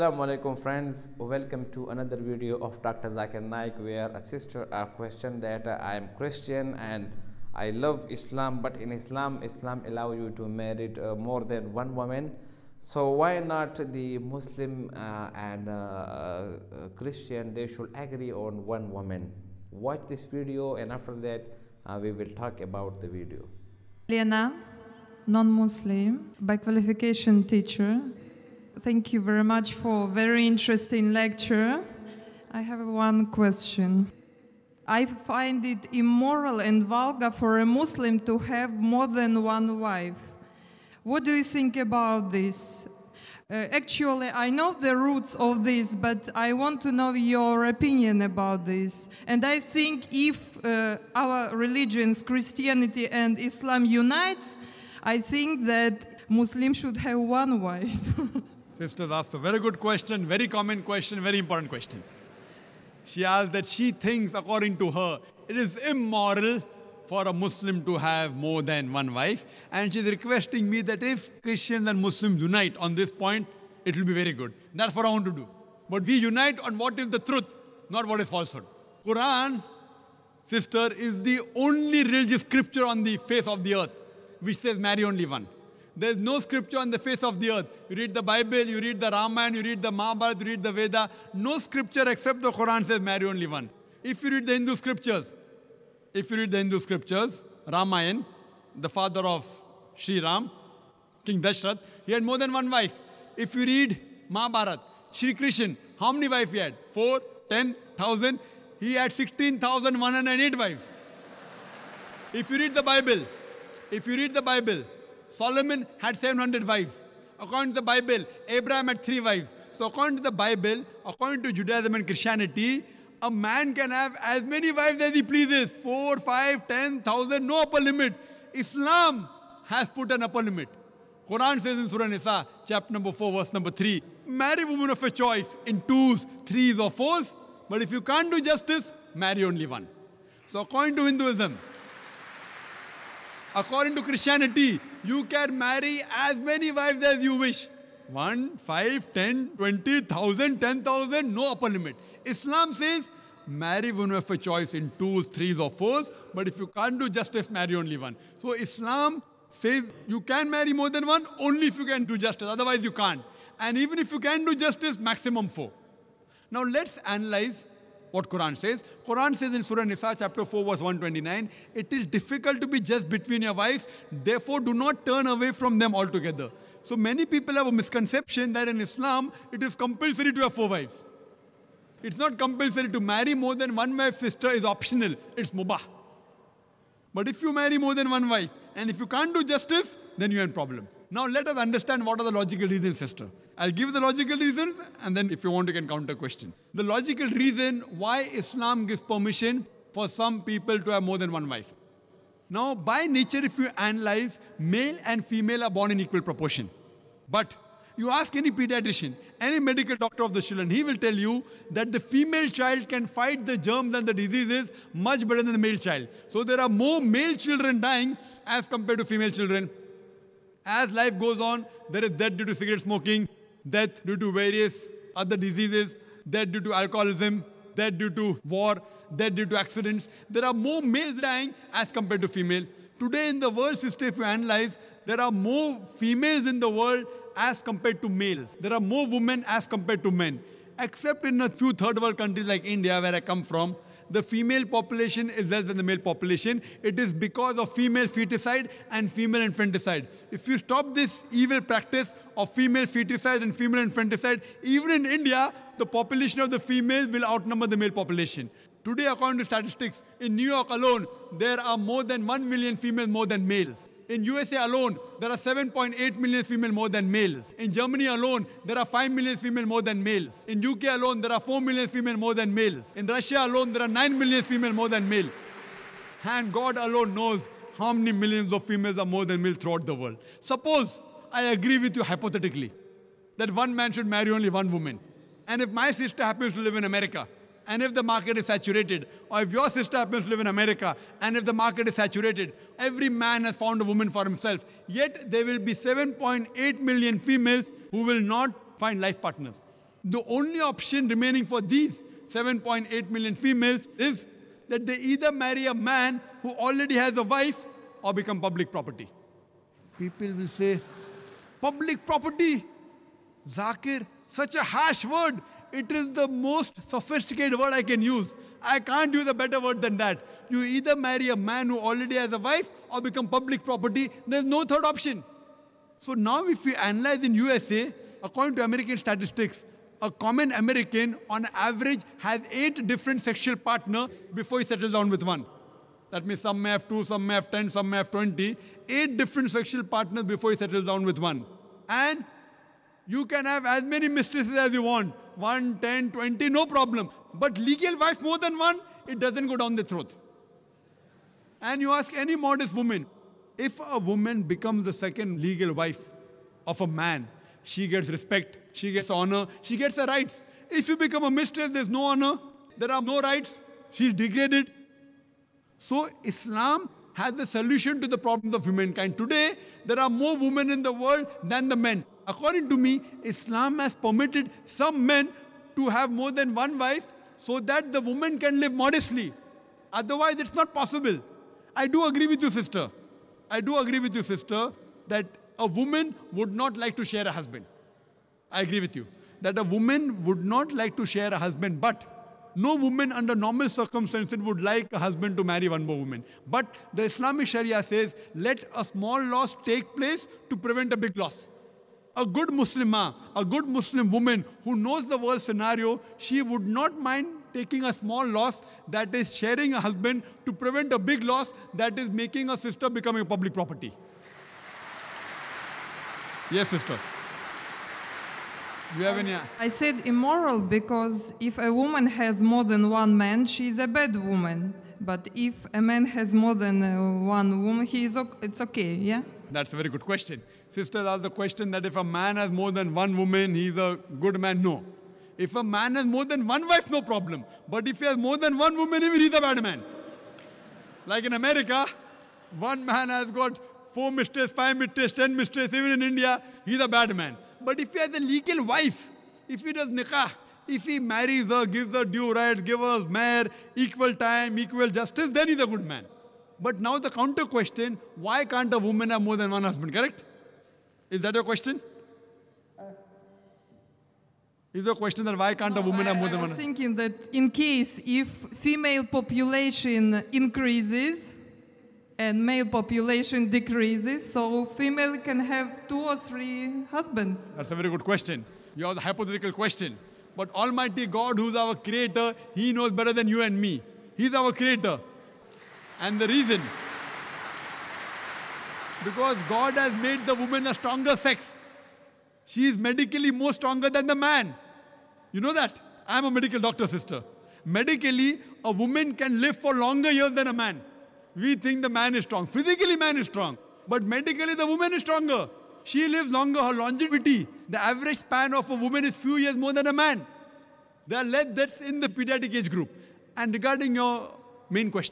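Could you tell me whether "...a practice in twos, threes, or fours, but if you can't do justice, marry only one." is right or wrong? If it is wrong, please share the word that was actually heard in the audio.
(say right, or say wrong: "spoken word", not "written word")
wrong: "choice", not "practice".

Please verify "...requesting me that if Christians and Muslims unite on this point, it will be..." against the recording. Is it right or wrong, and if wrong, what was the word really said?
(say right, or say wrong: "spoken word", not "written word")
right.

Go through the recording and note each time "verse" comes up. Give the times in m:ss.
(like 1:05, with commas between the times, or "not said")
2:13, 2:50.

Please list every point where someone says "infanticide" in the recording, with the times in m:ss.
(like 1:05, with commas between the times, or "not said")
4:09, 4:13.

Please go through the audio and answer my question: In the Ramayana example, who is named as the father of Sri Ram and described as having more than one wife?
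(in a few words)
King Dashrath.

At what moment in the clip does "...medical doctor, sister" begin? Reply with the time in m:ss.
8:16.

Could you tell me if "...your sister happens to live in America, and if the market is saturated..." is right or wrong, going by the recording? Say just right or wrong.
right.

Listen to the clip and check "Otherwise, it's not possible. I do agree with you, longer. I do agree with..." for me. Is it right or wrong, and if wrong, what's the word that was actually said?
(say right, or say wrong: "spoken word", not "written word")
wrong: "sister", not "longer".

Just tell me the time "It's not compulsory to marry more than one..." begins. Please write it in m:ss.
3:02.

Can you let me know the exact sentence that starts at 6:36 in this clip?
But the Islamic Sharia says, let a small loss take place to prevent a big loss.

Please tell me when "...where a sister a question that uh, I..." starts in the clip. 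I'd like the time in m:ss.
0:03.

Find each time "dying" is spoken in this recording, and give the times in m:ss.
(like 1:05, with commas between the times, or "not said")
3:37, 3:51.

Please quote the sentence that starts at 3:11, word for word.
Now let us understand what are the logical reasons, sister.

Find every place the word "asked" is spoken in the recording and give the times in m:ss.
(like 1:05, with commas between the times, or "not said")
0:59, 1:03, 7:11.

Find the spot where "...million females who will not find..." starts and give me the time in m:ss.
4:56.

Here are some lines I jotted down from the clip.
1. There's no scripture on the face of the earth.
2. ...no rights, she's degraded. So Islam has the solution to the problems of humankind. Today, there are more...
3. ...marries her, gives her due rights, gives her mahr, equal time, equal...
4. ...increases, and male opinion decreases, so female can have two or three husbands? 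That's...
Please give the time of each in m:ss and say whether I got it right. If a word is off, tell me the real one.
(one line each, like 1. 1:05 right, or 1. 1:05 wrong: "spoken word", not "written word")
1. 1:25 right
2. 6:03 right
3. 7:30 right
4. 7:50 wrong: "population", not "opinion".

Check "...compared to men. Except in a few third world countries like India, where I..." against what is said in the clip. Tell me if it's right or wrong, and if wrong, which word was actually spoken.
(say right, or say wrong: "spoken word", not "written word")
right.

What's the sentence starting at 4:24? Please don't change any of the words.
In USA alone, there are 7.8 million female more than males.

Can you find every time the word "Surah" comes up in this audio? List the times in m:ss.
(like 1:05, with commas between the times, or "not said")
2:11, 2:49.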